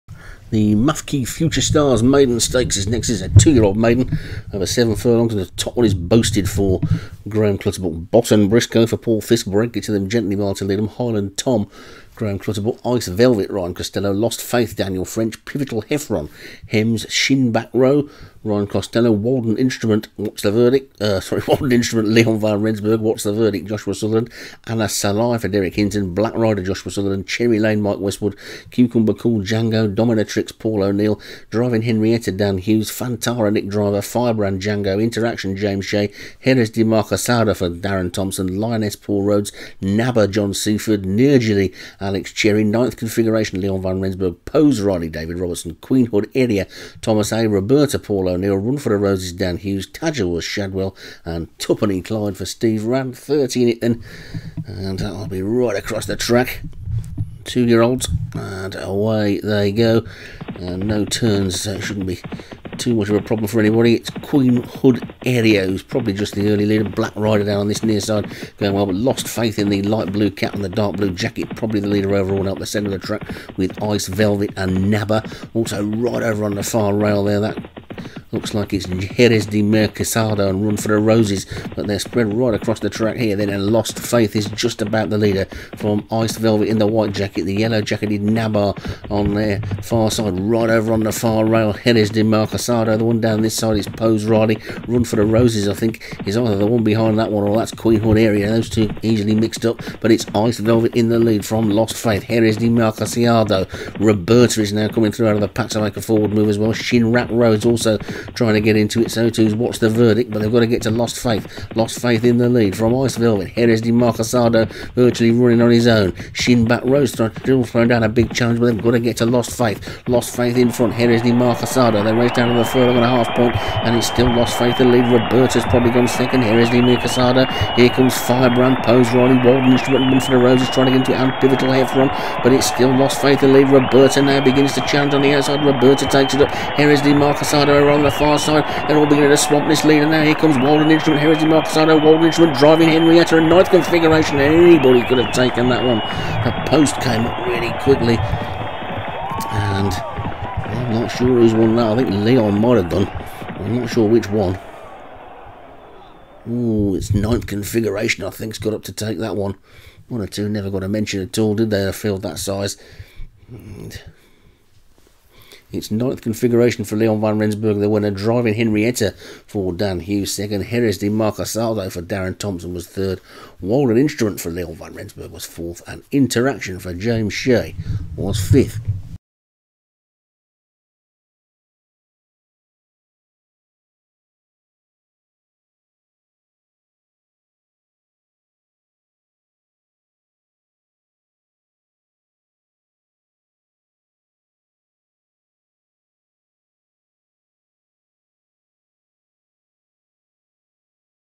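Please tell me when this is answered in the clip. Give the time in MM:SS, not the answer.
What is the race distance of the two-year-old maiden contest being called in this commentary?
00:04.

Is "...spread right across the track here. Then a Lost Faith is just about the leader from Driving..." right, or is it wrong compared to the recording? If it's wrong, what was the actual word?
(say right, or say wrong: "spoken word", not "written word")
wrong: "Iced", not "Driving".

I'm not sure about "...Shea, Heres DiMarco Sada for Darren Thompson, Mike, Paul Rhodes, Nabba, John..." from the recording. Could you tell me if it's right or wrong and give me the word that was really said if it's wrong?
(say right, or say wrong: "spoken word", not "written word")
wrong: "Lioness", not "Mike".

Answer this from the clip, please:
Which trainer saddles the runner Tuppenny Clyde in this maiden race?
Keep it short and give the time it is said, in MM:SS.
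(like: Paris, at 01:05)
Steve Rand, at 00:52.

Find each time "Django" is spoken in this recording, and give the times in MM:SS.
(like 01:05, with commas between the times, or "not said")
00:29, 00:34.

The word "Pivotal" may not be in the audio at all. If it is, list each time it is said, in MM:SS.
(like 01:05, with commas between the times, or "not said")
00:15, 02:11.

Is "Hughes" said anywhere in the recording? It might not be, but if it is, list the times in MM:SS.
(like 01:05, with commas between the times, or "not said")
00:32, 00:49, 02:50.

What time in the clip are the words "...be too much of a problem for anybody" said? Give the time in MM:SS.
01:02.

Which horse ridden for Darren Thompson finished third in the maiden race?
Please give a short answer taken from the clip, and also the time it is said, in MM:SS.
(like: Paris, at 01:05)
Jerez Di Marcasado, at 02:50.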